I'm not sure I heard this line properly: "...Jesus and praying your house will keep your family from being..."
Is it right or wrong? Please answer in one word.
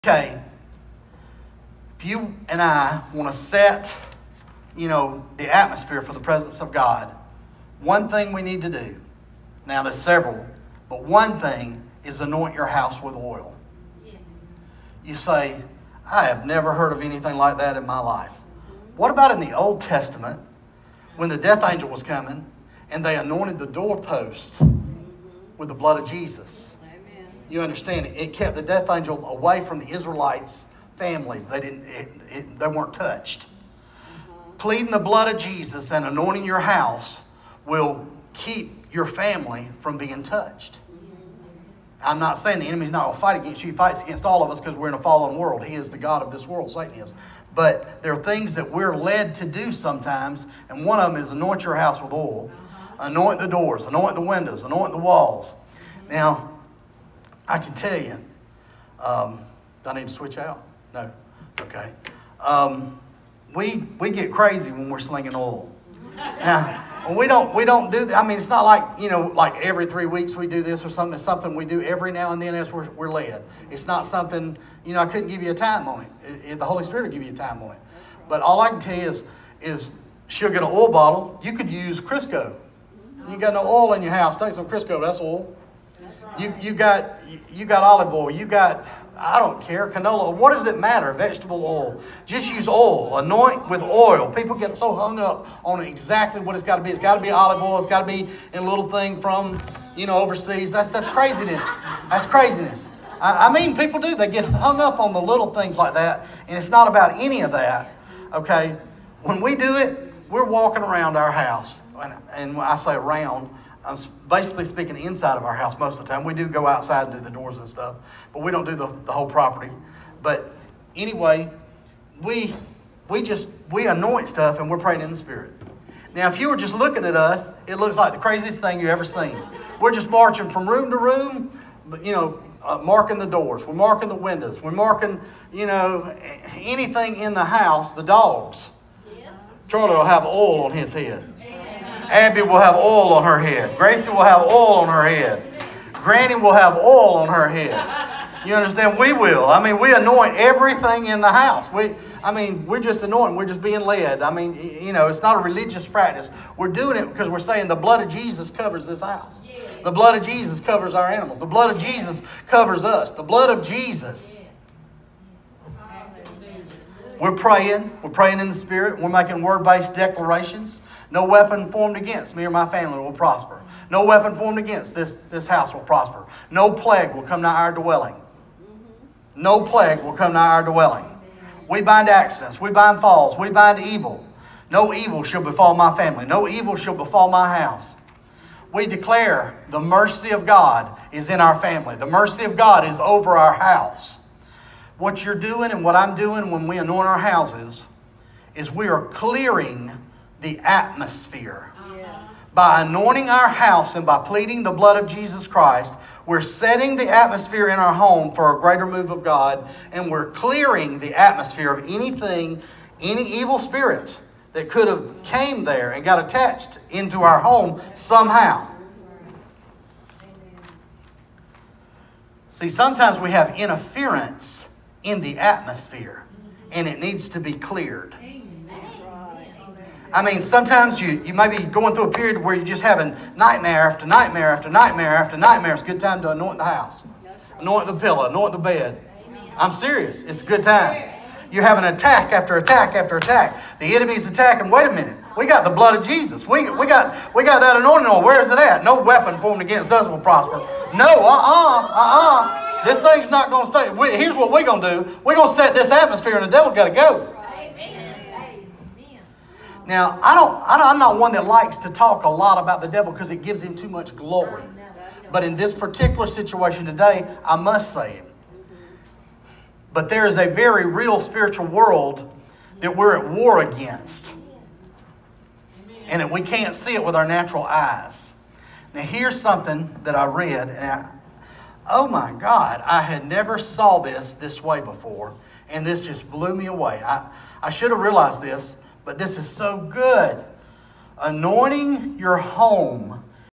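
wrong.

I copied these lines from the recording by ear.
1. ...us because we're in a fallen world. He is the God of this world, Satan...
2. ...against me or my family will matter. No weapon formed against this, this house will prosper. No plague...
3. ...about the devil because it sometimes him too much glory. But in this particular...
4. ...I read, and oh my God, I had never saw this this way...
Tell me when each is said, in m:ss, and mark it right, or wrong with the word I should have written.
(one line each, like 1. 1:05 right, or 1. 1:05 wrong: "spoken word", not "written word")
1. 0:44 right
2. 2:51 wrong: "prosper", not "matter"
3. 4:22 wrong: "gives", not "sometimes"
4. 4:40 right.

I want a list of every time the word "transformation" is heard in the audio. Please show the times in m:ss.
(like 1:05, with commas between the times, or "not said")
not said.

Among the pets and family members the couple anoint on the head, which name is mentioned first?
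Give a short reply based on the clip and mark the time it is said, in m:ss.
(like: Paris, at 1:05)
Charlie, at 2:19.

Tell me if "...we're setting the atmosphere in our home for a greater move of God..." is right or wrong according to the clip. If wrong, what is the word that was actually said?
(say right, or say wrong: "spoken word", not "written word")
right.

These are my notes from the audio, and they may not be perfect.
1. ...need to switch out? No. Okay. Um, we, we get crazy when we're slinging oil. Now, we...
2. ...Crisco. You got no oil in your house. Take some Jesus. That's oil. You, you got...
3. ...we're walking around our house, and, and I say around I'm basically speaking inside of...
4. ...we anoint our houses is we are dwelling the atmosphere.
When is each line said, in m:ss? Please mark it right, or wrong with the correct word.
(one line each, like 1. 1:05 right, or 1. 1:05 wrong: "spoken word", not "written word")
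1. 0:59 right
2. 1:21 wrong: "Crisco", not "Jesus"
3. 1:50 right
4. 3:16 wrong: "clearing", not "dwelling".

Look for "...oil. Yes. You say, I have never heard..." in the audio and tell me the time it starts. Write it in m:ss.
0:13.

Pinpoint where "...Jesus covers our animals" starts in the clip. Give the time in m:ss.
2:40.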